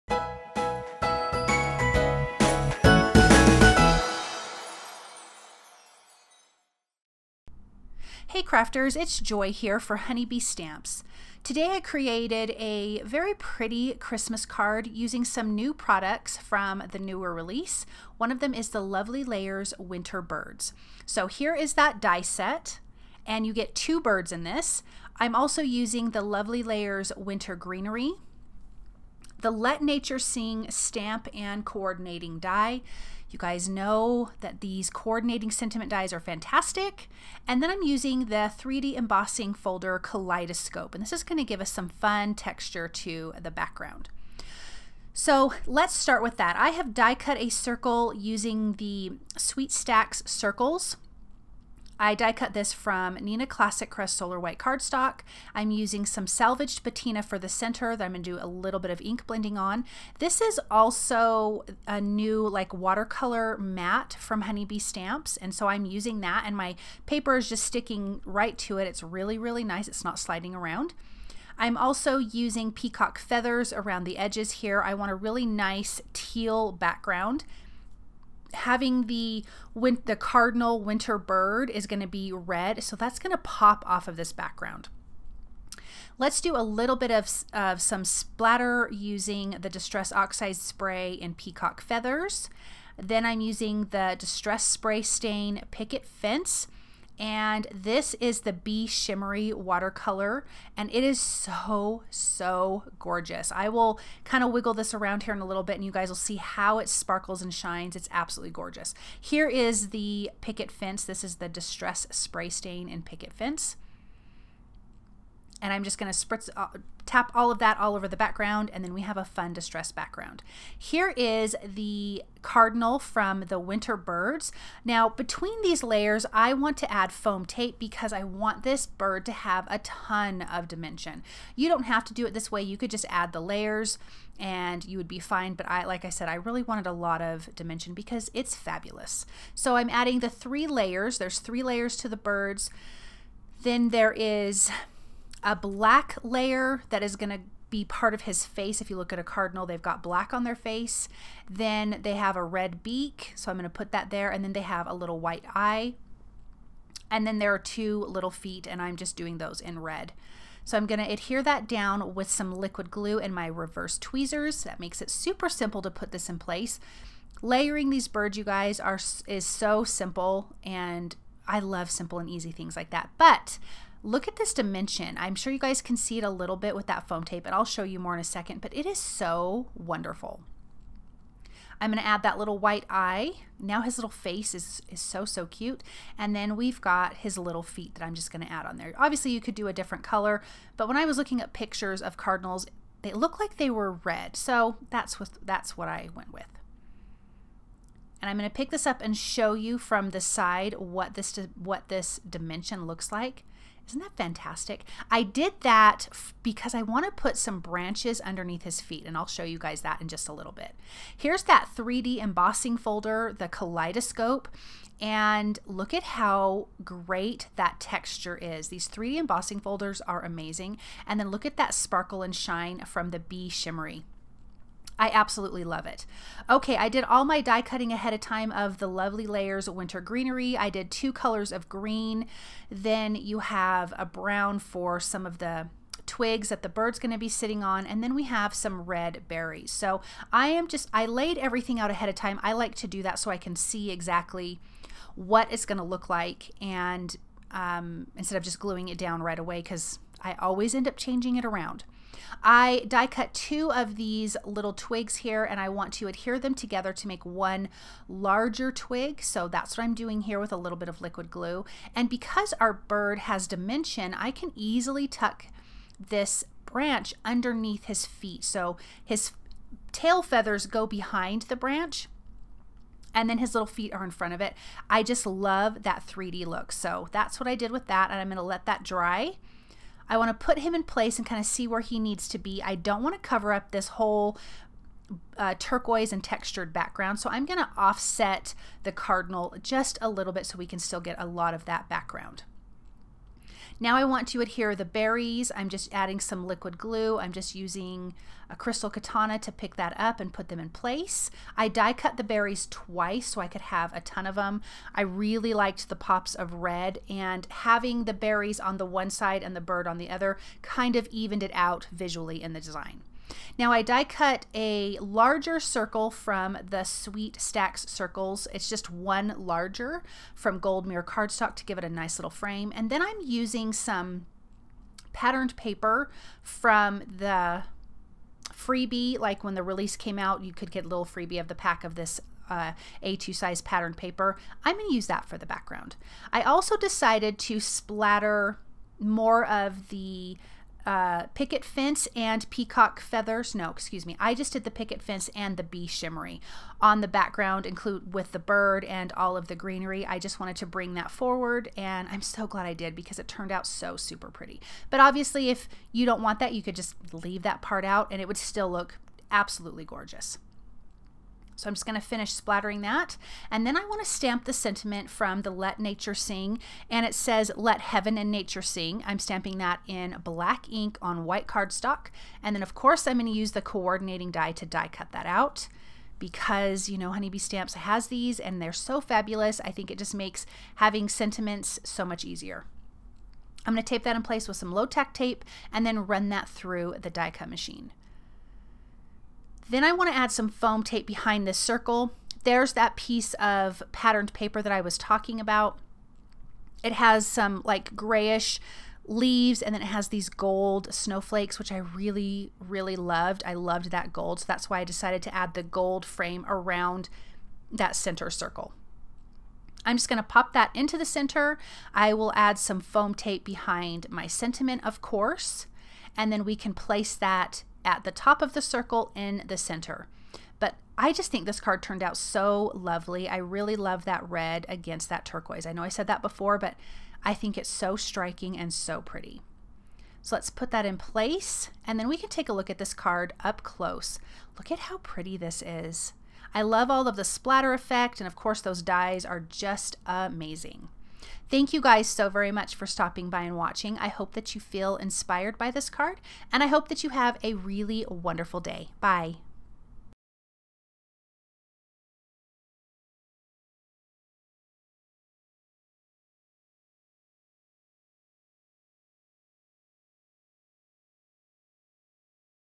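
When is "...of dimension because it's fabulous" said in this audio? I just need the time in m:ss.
2:17.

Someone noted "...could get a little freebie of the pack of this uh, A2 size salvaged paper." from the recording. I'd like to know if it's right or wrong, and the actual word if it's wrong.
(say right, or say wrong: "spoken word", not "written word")
wrong: "patterned", not "salvaged".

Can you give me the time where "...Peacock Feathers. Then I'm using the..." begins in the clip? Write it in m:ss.
1:31.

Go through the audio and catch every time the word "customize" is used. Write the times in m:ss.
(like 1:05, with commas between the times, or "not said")
not said.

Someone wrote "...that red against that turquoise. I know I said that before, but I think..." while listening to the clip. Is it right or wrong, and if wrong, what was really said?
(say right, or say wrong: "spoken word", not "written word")
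right.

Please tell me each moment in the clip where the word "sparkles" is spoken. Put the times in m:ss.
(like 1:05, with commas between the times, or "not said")
1:46, 3:41.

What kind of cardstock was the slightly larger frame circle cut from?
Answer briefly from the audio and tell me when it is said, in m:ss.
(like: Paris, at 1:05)
Gold mirror cardstock, at 5:20.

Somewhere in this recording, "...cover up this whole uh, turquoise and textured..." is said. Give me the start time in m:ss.
4:43.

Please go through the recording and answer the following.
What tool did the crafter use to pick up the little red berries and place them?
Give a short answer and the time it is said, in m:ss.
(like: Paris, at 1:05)
Crystal Katana, at 4:58.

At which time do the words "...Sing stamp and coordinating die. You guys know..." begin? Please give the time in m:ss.
0:30.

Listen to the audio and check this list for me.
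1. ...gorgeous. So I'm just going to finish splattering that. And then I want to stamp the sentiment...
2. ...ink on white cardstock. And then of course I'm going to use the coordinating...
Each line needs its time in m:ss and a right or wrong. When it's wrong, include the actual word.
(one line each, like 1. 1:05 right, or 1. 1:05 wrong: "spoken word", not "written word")
1. 5:59 right
2. 6:10 right.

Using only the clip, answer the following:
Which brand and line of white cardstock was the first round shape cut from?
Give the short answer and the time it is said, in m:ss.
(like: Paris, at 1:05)
Neenah Classic Crest Solar White, at 0:53.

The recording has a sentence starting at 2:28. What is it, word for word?
If you look at a cardinal, they've got black on their face.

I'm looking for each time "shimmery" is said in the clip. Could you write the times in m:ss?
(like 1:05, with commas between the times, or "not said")
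1:38, 3:43, 5:45.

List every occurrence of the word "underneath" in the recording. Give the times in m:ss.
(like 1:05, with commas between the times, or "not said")
3:28, 4:27.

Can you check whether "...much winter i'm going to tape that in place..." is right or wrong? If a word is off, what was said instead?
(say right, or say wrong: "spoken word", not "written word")
wrong: "easier", not "winter".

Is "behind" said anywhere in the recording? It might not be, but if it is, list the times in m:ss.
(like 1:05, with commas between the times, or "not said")
4:30, 6:31, 6:53.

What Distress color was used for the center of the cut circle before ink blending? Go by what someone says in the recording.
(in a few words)
Salvaged Patina.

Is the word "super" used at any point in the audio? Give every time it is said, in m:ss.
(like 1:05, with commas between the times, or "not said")
2:45, 5:53.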